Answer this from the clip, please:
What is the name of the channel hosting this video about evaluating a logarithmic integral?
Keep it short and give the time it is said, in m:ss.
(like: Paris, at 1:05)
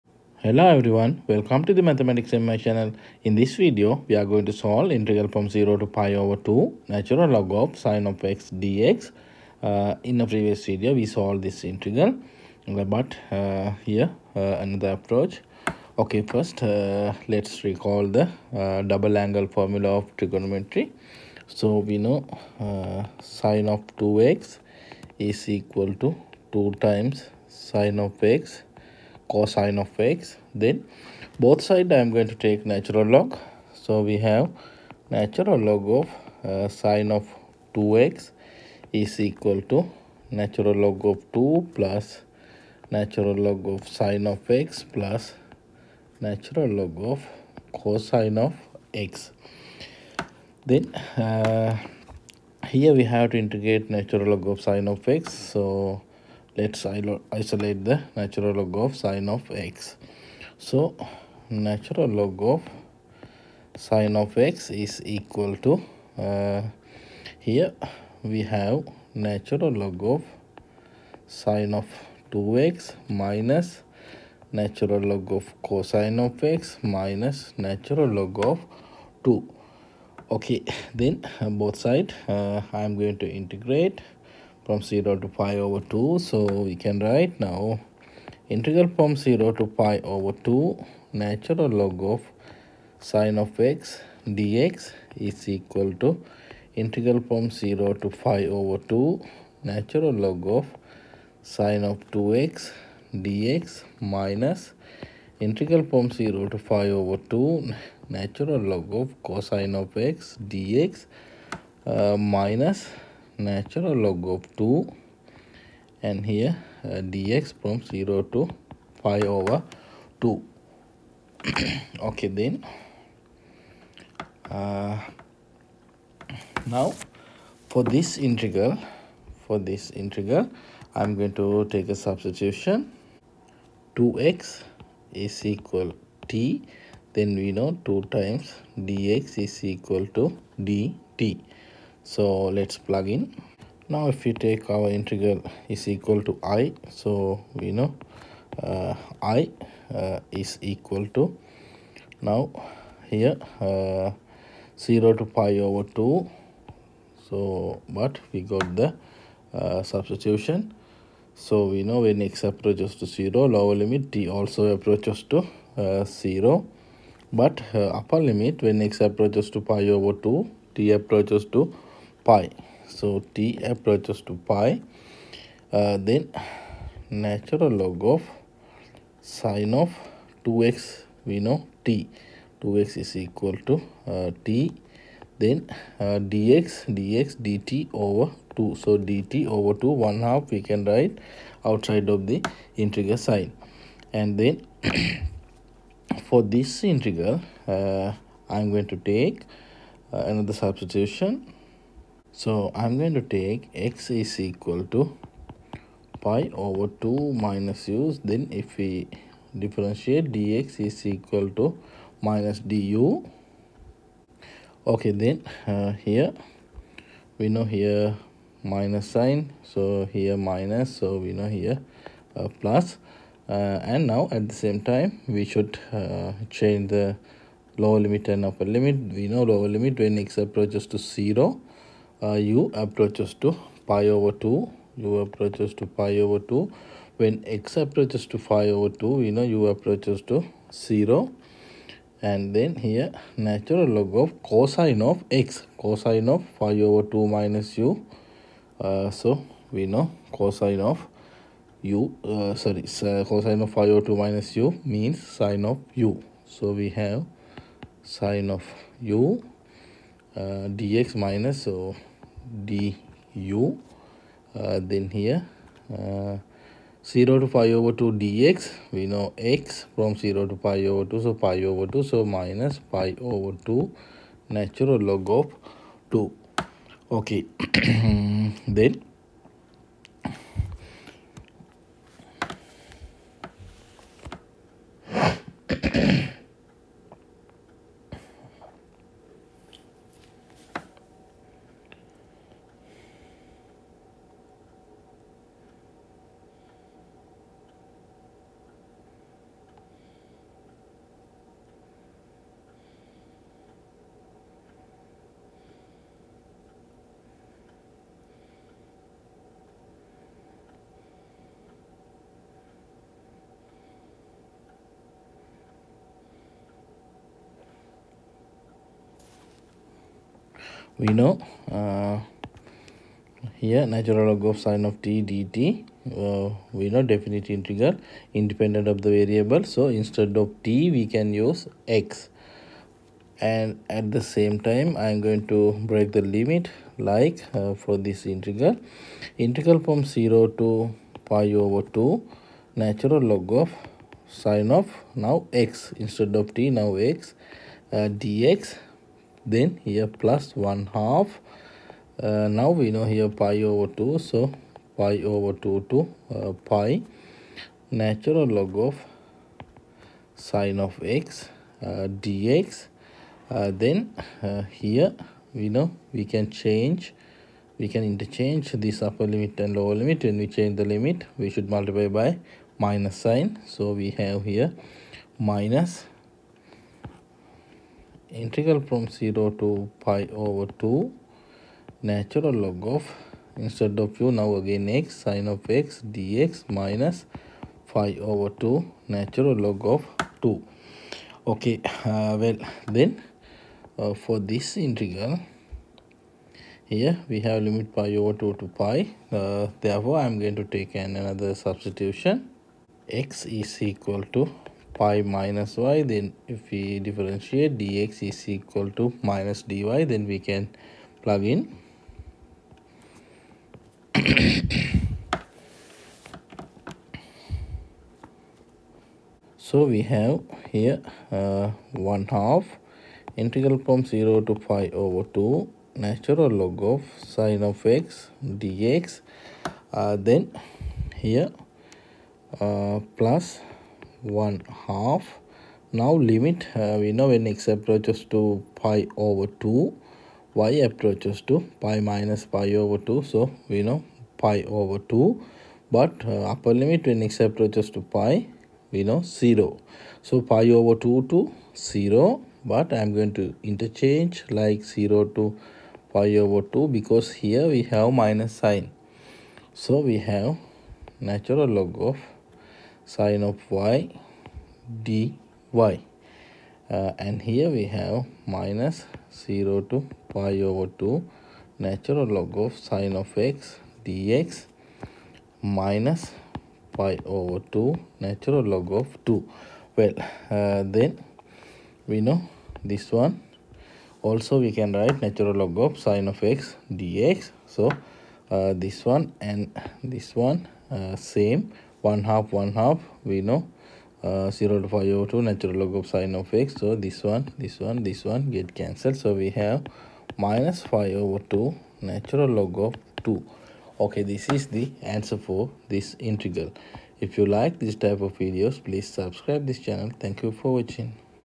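Mathematics MI, at 0:01.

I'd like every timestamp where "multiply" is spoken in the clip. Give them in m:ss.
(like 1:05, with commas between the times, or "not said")
6:11.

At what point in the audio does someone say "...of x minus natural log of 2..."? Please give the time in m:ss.
1:16.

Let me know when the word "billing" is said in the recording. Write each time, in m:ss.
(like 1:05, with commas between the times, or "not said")
not said.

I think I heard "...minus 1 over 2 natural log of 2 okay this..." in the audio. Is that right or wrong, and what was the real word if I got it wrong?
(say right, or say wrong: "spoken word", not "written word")
wrong: "5", not "1".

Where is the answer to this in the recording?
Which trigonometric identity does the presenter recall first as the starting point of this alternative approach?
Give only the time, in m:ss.
0:18.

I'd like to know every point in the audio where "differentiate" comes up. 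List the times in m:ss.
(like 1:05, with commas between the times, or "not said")
3:29, 6:47.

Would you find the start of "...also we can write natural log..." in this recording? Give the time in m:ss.
8:04.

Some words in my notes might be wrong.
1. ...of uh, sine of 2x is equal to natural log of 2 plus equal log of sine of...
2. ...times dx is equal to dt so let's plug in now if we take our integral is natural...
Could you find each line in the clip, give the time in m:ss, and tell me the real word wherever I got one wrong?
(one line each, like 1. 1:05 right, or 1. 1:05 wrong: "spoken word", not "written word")
1. 0:35 wrong: "natural", not "equal"
2. 2:18 wrong: "equal", not "natural".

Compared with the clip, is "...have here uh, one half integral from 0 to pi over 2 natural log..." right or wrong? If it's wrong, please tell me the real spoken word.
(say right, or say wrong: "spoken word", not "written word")
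right.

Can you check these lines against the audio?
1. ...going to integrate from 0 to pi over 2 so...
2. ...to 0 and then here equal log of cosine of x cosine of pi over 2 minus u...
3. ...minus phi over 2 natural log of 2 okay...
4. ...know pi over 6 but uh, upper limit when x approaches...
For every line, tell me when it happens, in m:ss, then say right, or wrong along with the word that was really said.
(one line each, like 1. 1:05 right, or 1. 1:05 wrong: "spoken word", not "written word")
1. 1:22 right
2. 4:00 wrong: "natural", not "equal"
3. 6:26 right
4. 7:23 wrong: "2", not "6".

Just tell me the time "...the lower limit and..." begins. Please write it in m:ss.
3:46.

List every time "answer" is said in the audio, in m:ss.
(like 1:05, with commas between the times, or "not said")
8:25.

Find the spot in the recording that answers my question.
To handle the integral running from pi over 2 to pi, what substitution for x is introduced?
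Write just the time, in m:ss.
6:43.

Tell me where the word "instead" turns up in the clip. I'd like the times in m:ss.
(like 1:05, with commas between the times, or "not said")
5:30, 5:46, 6:23.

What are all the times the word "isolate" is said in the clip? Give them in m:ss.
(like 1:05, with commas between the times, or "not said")
0:57.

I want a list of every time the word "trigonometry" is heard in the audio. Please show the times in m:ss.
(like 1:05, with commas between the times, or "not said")
0:20.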